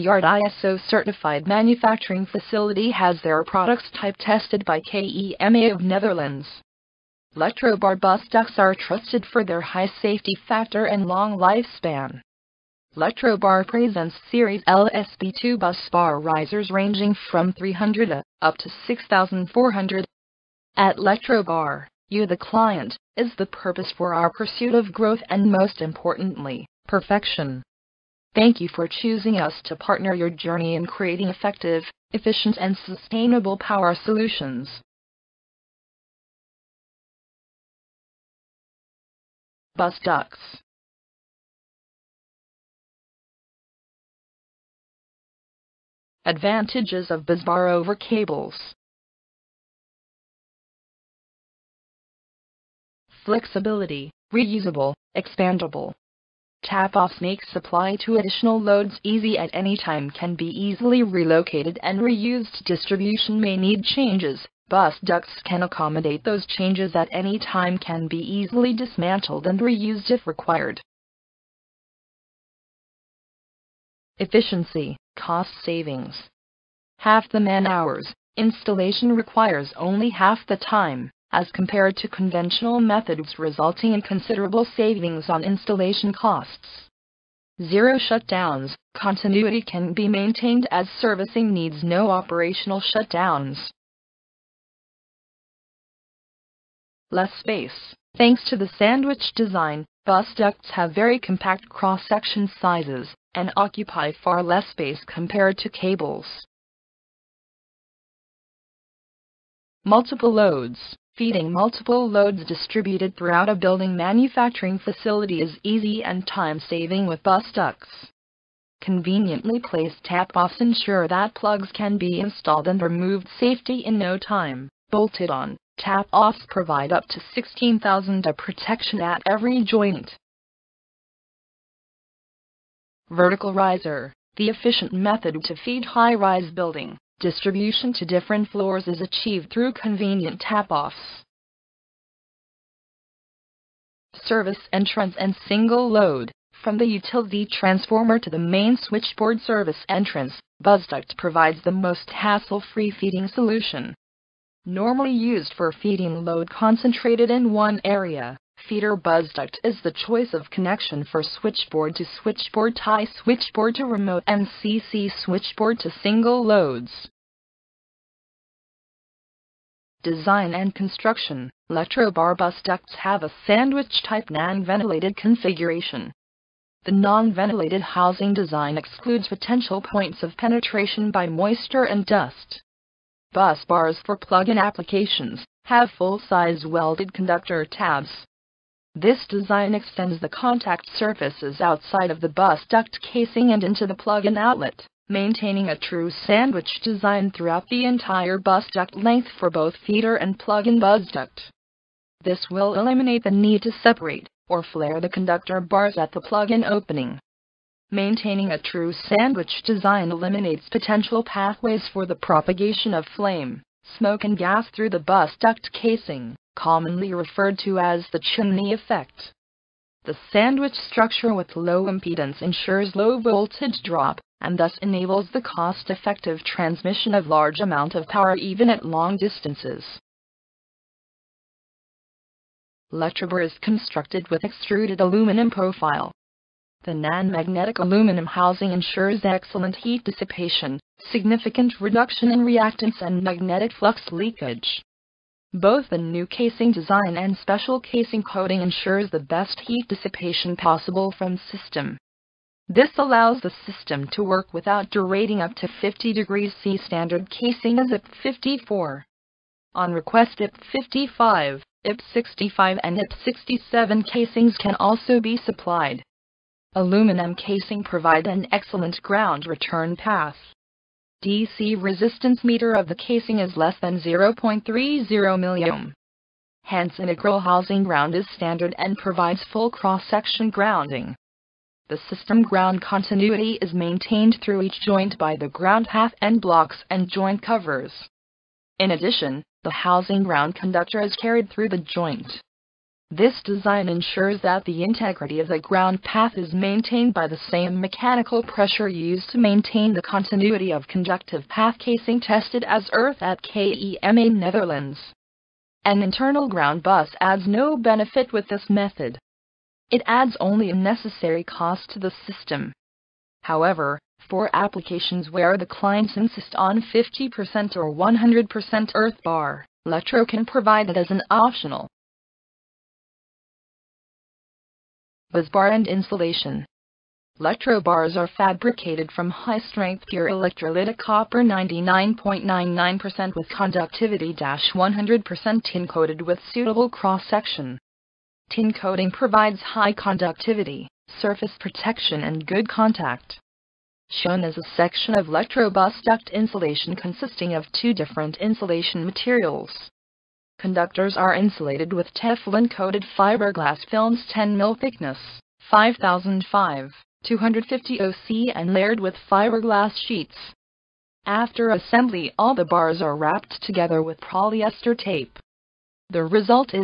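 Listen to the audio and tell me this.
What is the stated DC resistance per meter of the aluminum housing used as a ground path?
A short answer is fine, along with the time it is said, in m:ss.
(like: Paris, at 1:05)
less than 0.30 milliohm, at 4:33.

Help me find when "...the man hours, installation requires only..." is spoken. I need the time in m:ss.
1:17.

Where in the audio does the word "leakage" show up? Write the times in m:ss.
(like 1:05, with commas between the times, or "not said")
4:04.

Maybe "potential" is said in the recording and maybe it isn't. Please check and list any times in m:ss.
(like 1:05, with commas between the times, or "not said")
2:59, 3:30.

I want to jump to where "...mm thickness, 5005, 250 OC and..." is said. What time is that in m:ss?
5:54.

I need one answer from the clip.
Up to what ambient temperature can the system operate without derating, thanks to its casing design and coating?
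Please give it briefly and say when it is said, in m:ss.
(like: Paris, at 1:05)
50 degrees C, at 4:15.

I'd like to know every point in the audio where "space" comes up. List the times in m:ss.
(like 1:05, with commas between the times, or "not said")
1:37, 1:44.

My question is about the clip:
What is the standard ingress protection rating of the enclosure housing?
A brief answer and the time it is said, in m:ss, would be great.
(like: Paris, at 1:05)
IP 54, at 4:17.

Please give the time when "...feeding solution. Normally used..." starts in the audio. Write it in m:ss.
2:32.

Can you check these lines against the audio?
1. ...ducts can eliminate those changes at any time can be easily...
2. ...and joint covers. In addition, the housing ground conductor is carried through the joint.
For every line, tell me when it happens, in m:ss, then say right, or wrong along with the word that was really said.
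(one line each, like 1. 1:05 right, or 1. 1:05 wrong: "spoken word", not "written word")
1. 1:05 wrong: "accommodate", not "eliminate"
2. 4:46 right.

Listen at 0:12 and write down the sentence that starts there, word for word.
Electrobar presents series LSB2 bus bar risers ranging from 300 up to 6,400.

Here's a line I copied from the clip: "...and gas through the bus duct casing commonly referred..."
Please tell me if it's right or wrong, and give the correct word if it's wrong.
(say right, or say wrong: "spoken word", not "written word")
right.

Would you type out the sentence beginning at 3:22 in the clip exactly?
This will eliminate the need to separate or flare the conductor bars at the plug-in opening.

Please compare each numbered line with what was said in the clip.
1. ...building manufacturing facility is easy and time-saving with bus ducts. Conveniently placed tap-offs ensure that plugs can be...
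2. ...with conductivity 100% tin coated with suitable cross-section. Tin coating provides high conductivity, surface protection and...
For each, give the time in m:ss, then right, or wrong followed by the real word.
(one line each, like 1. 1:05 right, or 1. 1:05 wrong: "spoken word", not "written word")
1. 1:53 right
2. 5:33 right.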